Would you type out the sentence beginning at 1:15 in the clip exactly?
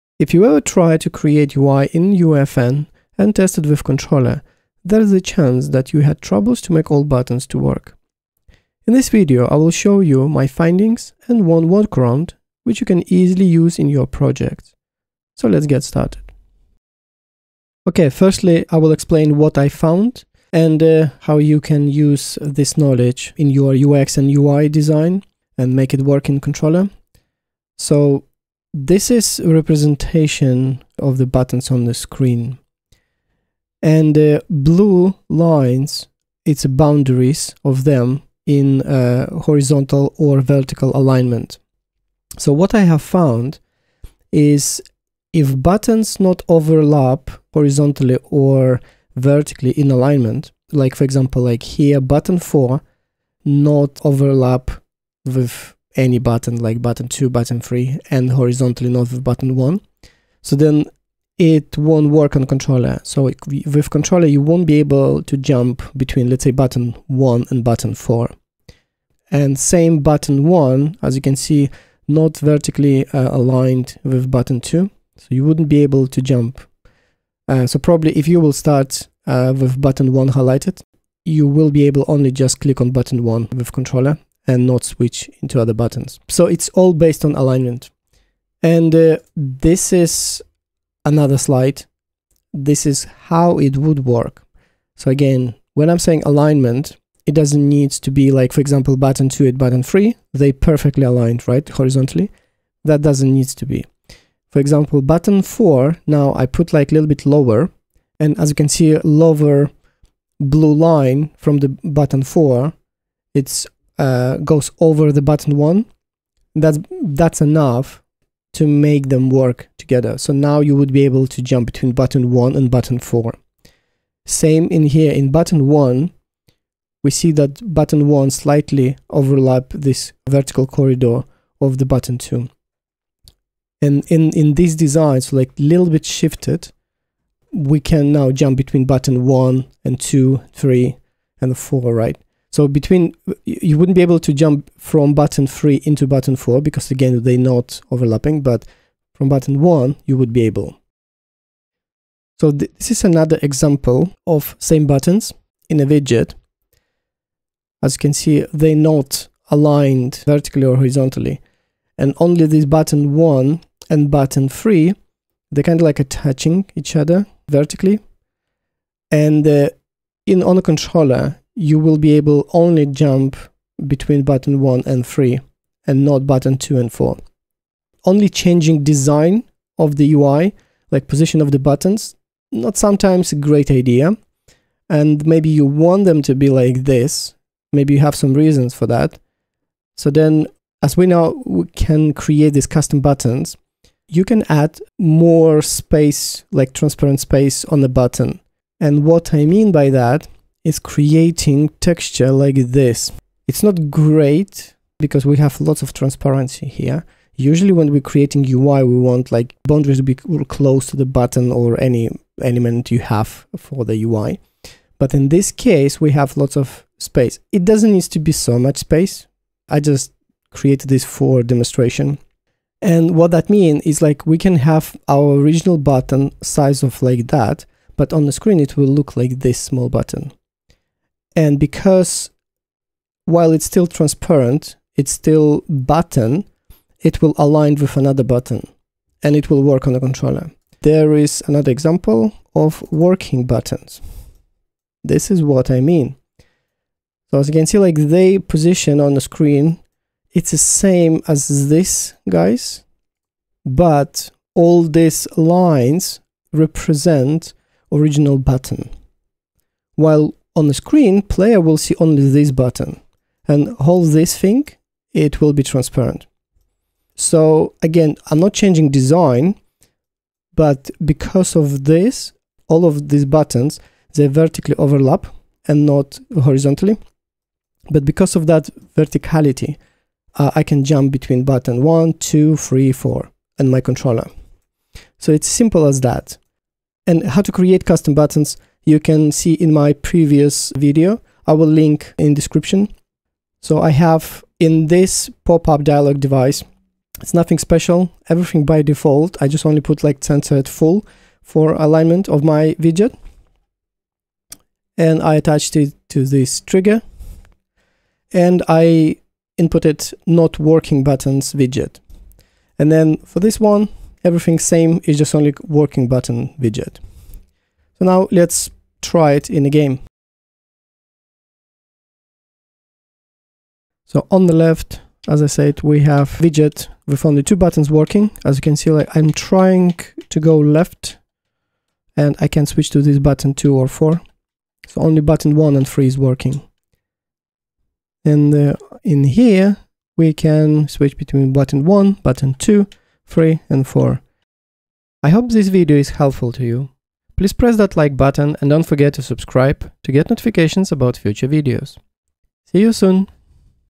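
So you wouldn't be able to jump.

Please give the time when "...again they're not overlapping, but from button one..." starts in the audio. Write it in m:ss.
2:26.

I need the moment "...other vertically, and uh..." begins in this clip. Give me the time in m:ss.
2:46.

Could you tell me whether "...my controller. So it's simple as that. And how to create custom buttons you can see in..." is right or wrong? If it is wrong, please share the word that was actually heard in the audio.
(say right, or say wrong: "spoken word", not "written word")
right.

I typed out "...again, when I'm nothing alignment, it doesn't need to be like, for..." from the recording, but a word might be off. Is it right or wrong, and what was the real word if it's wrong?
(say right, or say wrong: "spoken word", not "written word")
wrong: "saying", not "nothing".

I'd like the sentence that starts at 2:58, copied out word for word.
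Only changing design of the UI, like position of the buttons, not sometimes a great idea.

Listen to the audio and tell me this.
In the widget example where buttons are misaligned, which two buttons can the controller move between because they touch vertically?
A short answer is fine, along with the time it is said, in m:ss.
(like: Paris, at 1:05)
Buttons 1 and 3, at 2:54.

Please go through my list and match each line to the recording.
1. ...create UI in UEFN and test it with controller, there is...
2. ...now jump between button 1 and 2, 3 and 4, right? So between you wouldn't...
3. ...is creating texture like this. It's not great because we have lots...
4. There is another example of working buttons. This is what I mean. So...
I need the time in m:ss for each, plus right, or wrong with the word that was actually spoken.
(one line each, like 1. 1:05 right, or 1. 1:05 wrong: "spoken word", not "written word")
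1. 0:01 right
2. 2:18 right
3. 3:20 right
4. 4:00 right.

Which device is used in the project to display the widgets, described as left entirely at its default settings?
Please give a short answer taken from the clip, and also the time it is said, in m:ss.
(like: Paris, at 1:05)
Pop-up dialog device, at 4:55.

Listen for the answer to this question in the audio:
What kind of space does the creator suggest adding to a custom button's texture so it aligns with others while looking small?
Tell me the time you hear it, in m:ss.
3:16.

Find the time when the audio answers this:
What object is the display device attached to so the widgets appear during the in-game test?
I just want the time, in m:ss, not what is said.
5:06.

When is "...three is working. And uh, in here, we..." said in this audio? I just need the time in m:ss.
5:35.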